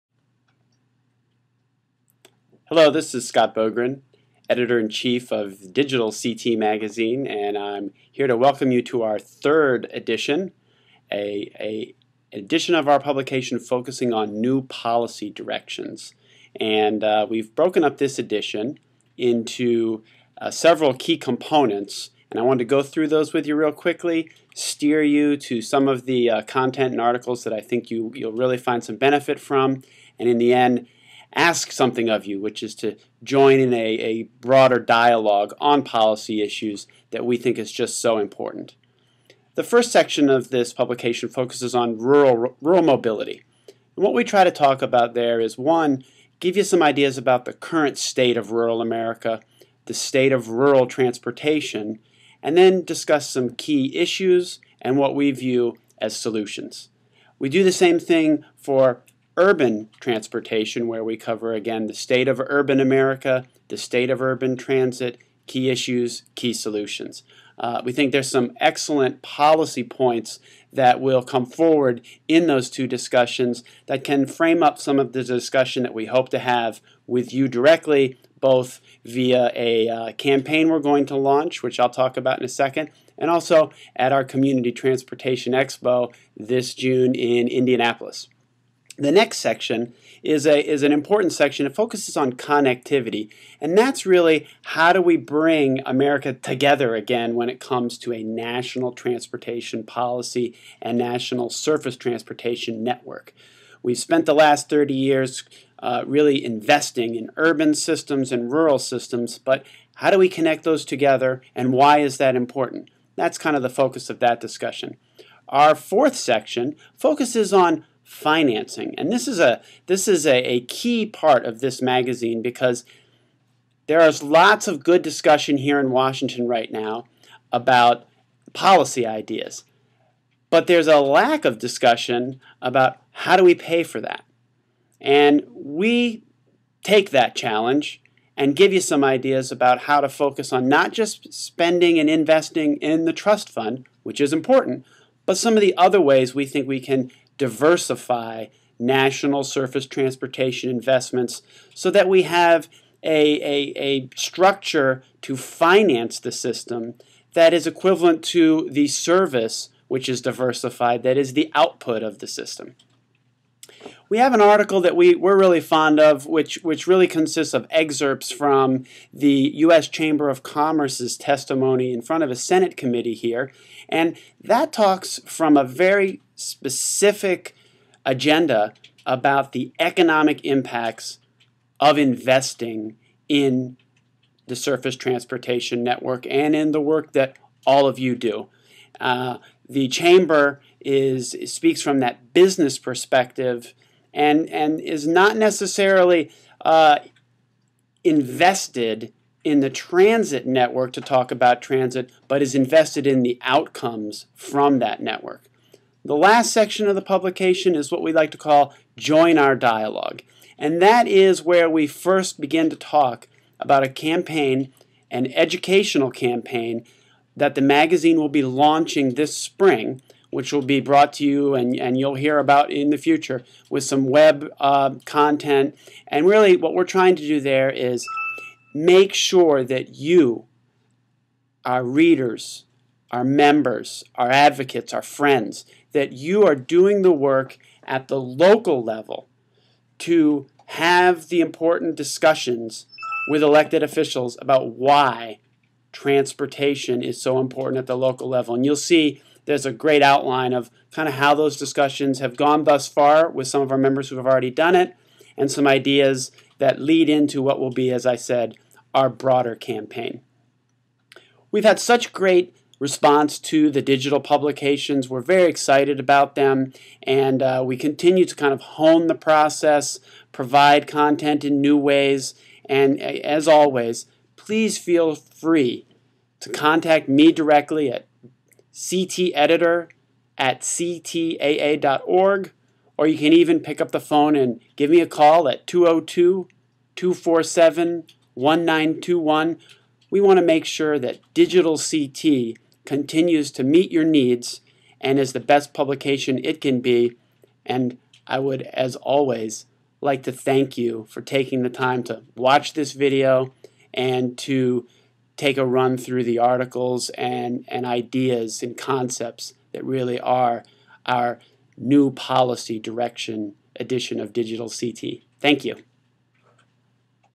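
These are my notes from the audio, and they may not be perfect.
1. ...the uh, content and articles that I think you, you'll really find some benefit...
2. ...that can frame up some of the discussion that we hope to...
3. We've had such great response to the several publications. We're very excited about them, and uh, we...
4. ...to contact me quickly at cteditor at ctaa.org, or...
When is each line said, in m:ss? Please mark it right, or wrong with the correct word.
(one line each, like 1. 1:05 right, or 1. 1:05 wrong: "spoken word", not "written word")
1. 0:26 right
2. 1:13 right
3. 4:21 wrong: "digital", not "several"
4. 4:36 wrong: "directly", not "quickly".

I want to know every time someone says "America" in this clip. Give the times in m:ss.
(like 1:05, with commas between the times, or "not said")
0:48, 1:02, 1:35.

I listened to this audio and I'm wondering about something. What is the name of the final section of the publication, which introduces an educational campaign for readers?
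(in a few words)
Join Our Dialogue.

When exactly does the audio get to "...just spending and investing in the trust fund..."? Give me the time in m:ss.
2:20.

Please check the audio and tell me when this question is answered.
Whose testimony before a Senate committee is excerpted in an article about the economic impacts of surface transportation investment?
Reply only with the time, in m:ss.
2:49.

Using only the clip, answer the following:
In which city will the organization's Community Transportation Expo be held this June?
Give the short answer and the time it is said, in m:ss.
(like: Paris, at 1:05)
Indianapolis, at 1:27.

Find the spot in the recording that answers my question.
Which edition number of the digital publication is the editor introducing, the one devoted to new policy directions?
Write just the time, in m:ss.
0:09.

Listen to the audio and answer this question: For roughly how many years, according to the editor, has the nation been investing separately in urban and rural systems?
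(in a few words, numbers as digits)
30 years.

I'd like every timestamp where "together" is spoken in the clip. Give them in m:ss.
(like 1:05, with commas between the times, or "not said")
1:36, 1:50.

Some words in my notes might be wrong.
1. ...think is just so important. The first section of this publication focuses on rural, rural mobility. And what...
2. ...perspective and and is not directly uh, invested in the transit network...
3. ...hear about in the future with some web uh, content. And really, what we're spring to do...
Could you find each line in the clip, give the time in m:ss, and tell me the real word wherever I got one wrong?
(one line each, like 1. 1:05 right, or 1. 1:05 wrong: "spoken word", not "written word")
1. 0:37 right
2. 3:12 wrong: "necessarily", not "directly"
3. 3:42 wrong: "trying", not "spring".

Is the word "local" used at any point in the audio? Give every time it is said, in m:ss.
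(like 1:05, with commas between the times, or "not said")
3:58, 4:07.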